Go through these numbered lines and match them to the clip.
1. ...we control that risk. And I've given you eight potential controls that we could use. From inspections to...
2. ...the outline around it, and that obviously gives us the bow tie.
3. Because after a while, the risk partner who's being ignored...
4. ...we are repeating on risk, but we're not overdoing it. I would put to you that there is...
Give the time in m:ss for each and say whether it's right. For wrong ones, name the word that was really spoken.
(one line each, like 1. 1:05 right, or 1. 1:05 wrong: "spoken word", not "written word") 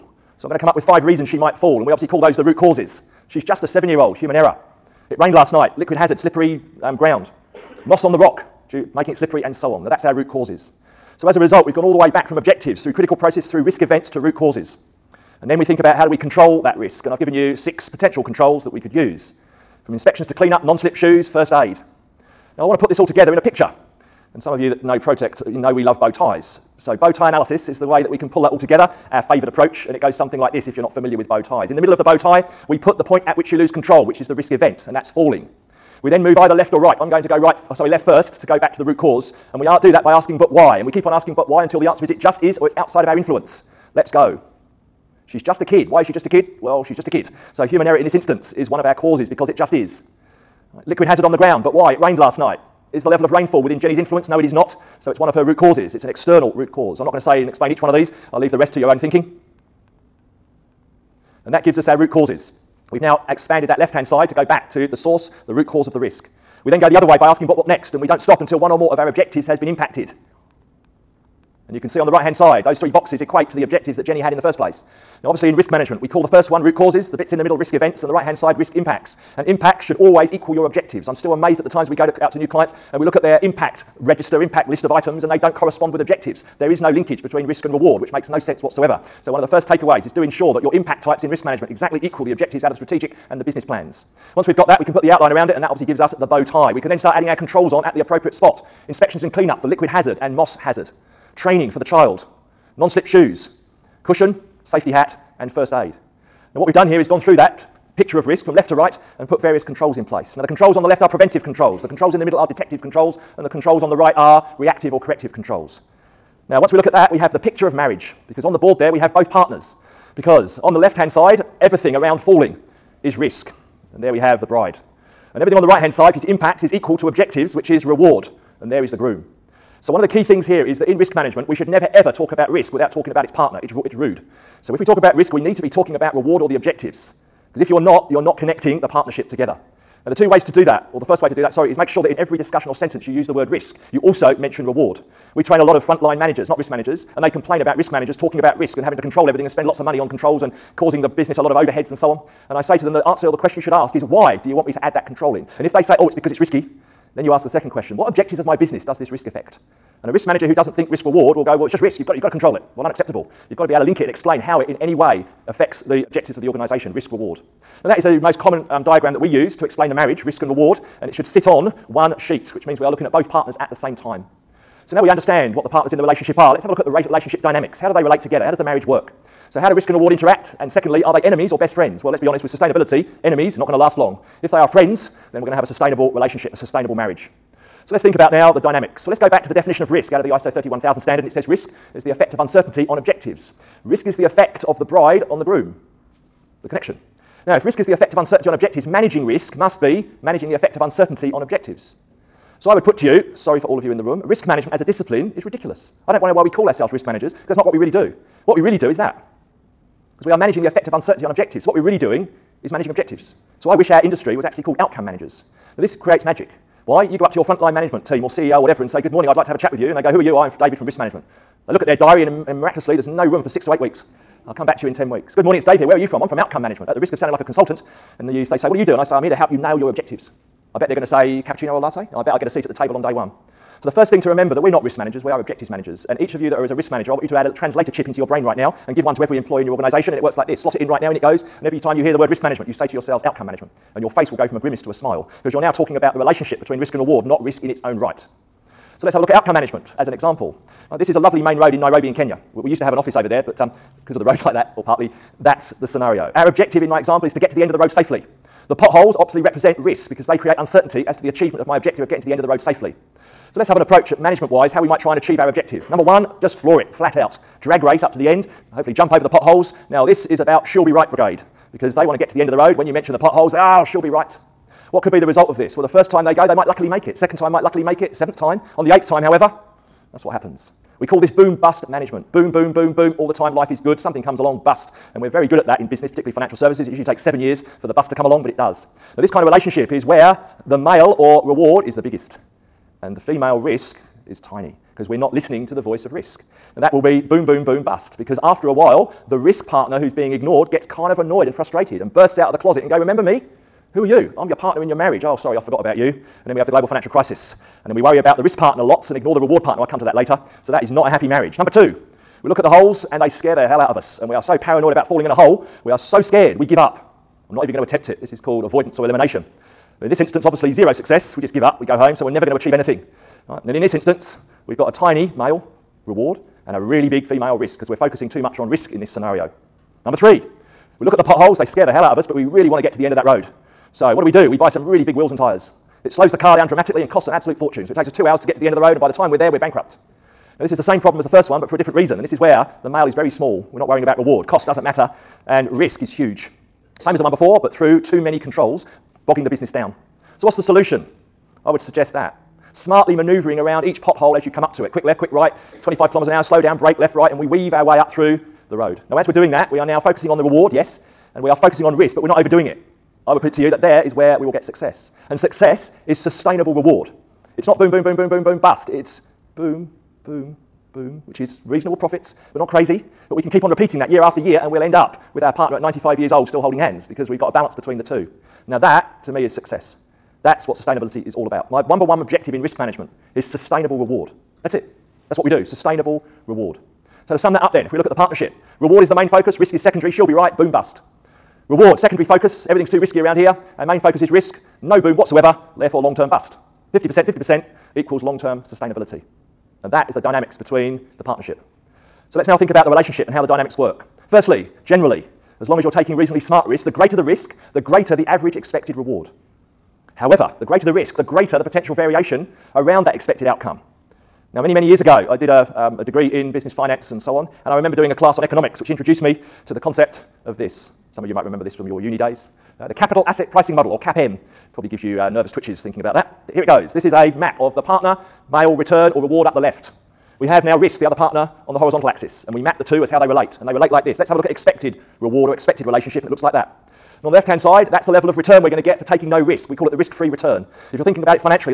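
1. 0:16 wrong: "six", not "eight"
2. 1:35 right
3. 4:58 right
4. 6:01 wrong: "focusing", not "repeating".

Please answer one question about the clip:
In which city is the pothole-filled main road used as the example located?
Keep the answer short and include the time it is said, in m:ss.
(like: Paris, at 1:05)
Nairobi, at 4:11.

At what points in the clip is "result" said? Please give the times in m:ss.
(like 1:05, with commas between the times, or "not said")
0:11, 4:35.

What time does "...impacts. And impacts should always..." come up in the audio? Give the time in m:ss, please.
1:18.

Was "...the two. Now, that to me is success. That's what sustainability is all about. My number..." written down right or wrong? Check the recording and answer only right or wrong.
right.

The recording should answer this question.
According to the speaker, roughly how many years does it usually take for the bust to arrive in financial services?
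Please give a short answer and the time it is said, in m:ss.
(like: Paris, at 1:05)
7 years, at 4:47.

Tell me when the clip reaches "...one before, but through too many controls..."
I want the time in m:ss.
5:47.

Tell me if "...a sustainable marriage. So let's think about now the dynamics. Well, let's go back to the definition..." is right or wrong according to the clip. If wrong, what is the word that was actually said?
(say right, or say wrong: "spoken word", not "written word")
right.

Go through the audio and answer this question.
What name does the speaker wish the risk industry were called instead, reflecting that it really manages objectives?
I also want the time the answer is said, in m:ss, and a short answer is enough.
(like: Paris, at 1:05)
Outcome managers, at 3:34.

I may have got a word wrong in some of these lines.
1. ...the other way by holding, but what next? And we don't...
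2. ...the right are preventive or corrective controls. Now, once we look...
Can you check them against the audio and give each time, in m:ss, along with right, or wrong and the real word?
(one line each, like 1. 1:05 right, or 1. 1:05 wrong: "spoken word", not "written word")
1. 1:06 wrong: "asking", not "holding"
2. 1:53 wrong: "reactive", not "preventive".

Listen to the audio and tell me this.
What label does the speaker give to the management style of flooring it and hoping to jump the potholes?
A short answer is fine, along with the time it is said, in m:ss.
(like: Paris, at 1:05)
Boom bust management, at 4:41.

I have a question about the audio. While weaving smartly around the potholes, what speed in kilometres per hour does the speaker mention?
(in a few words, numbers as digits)
25.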